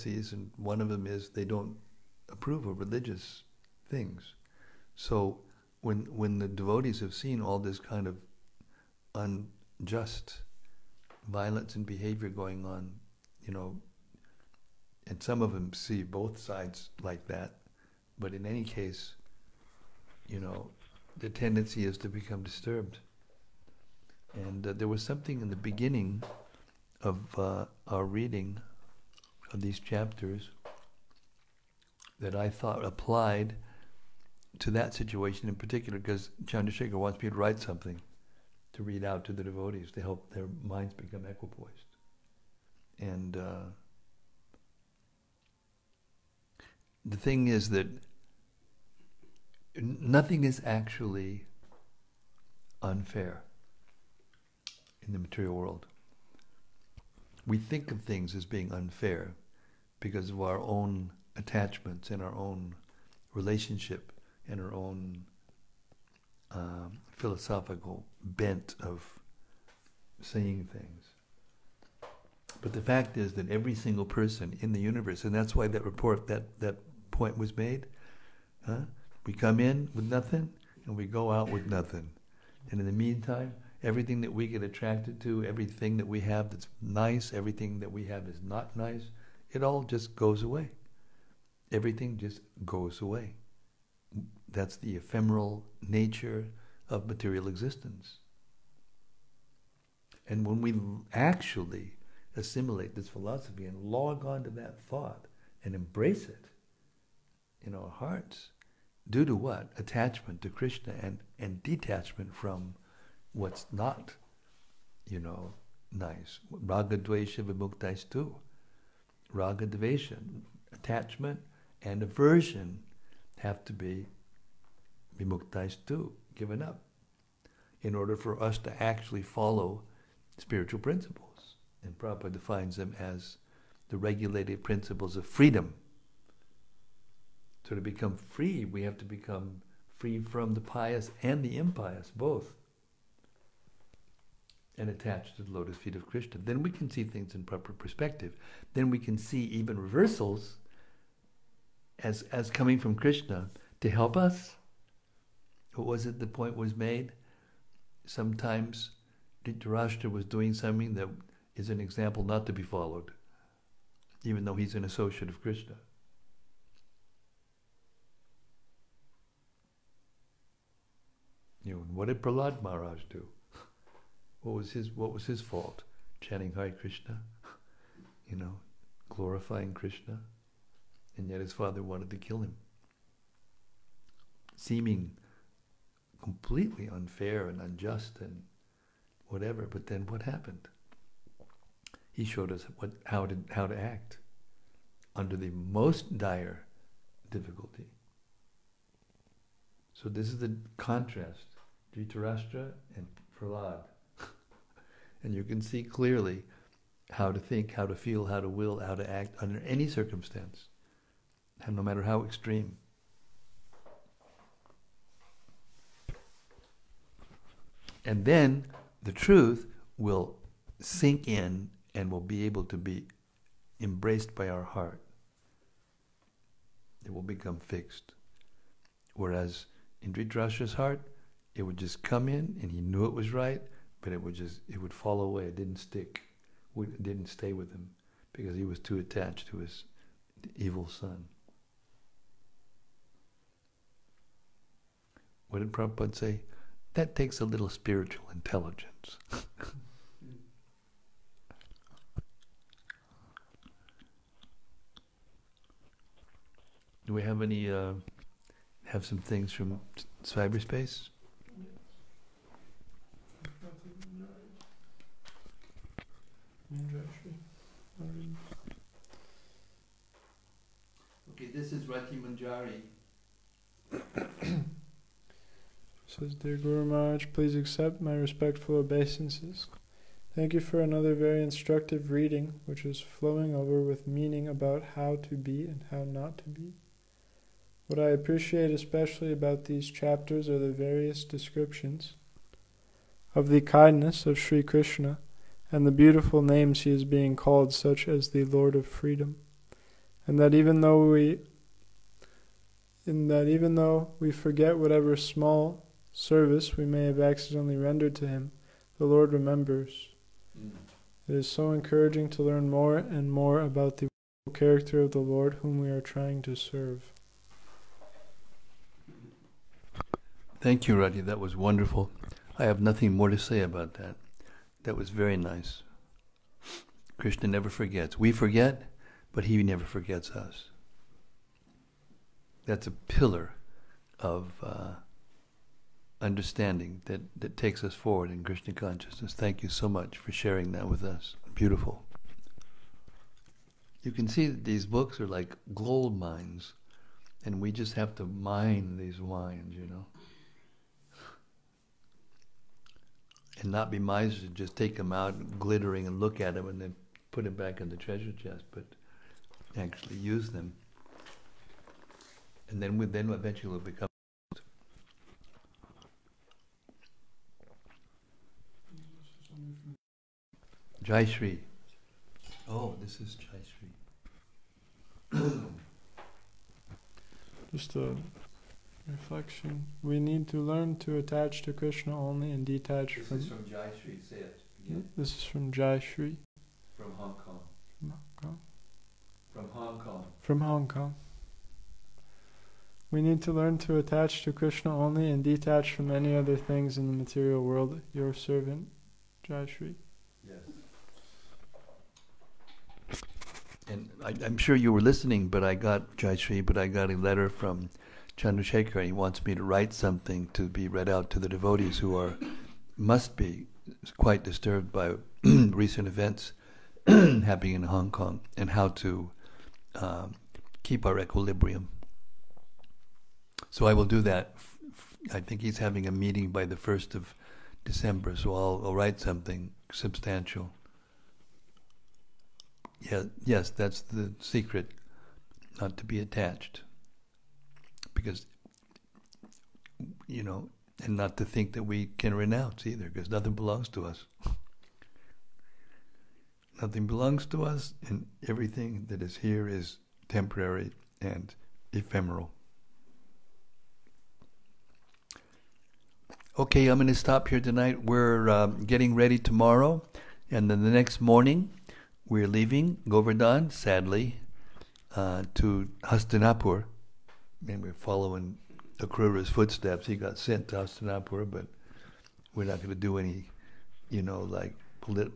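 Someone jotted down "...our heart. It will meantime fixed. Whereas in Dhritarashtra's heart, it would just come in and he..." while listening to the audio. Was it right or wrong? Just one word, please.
wrong.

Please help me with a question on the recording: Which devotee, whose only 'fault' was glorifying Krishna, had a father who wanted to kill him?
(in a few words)
Prahlad Maharaj.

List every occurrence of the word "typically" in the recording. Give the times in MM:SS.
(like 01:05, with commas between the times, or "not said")
not said.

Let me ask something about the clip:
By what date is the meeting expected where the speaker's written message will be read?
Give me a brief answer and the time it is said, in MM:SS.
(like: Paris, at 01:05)
1st of December, at 07:06.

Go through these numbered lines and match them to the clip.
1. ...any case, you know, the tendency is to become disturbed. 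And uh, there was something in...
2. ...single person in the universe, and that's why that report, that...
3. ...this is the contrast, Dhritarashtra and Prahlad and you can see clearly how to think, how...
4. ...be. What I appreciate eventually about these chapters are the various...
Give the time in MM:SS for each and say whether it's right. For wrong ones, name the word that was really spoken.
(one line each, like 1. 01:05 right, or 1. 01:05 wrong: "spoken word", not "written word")
1. 00:18 right
2. 01:13 right
3. 03:20 right
4. 04:46 wrong: "especially", not "eventually".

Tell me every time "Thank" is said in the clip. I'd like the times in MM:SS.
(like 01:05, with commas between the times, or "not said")
04:40, 05:20, 05:39.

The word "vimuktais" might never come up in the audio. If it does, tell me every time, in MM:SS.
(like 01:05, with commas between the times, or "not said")
01:57, 02:05.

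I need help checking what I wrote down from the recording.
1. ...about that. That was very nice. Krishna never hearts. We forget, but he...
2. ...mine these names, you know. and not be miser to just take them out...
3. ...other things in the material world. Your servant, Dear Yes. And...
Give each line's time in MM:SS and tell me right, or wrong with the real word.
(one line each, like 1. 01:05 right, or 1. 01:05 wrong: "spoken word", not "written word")
1. 05:23 wrong: "forgets", not "hearts"
2. 05:48 wrong: "wines", not "names"
3. 06:36 wrong: "Jai", not "Dear".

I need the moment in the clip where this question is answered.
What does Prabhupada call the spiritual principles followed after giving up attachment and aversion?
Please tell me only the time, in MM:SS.
02:13.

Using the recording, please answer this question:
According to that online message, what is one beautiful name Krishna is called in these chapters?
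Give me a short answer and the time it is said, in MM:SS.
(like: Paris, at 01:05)
the Lord of Freedom, at 04:58.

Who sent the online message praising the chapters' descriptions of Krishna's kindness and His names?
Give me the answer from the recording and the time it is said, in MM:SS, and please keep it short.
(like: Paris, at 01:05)
Rati Manjari, at 04:31.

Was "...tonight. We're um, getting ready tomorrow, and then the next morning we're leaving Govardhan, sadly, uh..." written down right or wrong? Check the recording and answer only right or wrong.
right.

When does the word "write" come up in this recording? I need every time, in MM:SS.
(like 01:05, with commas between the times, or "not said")
00:37, 06:49, 07:08.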